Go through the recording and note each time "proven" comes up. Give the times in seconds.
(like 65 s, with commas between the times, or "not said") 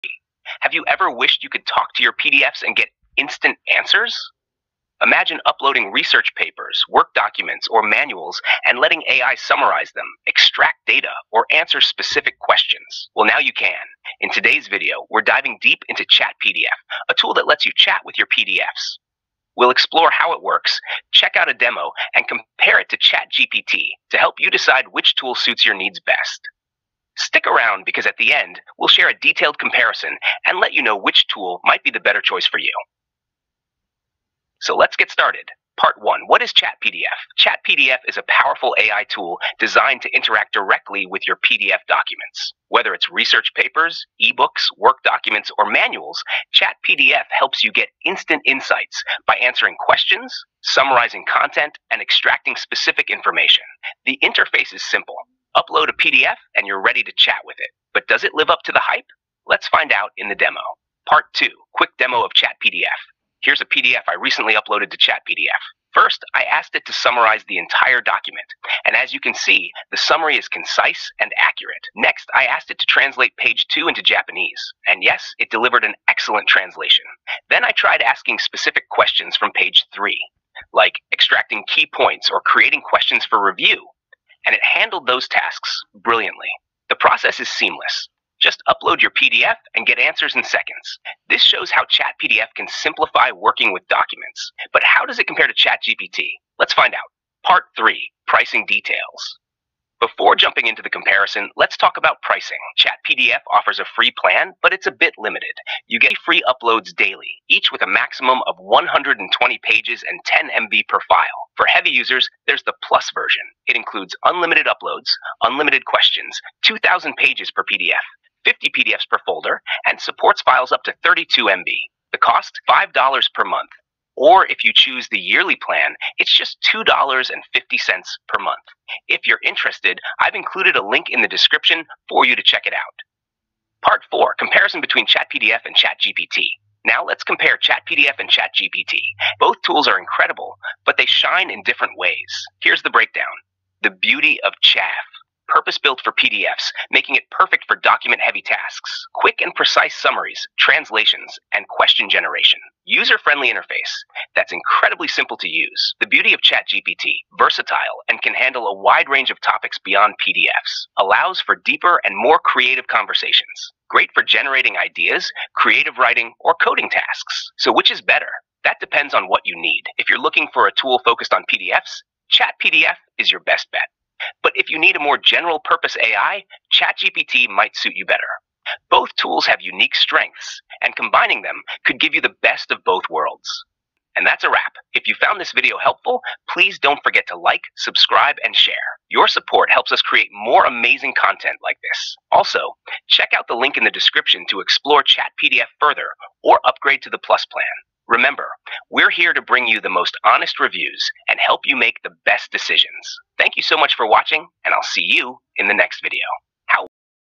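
not said.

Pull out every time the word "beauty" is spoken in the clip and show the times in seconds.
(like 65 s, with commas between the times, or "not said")
143 s, 156 s.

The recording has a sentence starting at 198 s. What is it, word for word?
Remember, we're here to bring you the most honest reviews and help you make the best decisions.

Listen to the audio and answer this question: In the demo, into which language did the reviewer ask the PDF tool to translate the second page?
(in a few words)
Japanese.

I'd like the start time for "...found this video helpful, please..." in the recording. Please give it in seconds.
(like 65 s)
185 s.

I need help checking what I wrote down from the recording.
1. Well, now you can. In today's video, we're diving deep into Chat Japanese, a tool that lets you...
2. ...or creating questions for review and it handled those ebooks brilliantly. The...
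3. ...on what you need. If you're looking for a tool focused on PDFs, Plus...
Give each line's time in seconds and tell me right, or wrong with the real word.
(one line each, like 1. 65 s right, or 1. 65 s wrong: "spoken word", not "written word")
1. 13 s wrong: "PDF", not "Japanese"
2. 82 s wrong: "tasks", not "ebooks"
3. 169 s wrong: "Chat", not "Plus".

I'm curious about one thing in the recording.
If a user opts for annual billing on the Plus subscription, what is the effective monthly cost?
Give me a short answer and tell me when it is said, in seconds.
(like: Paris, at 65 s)
$2.50, at 126 s.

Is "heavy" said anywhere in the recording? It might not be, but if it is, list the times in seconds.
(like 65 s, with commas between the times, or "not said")
111 s, 148 s.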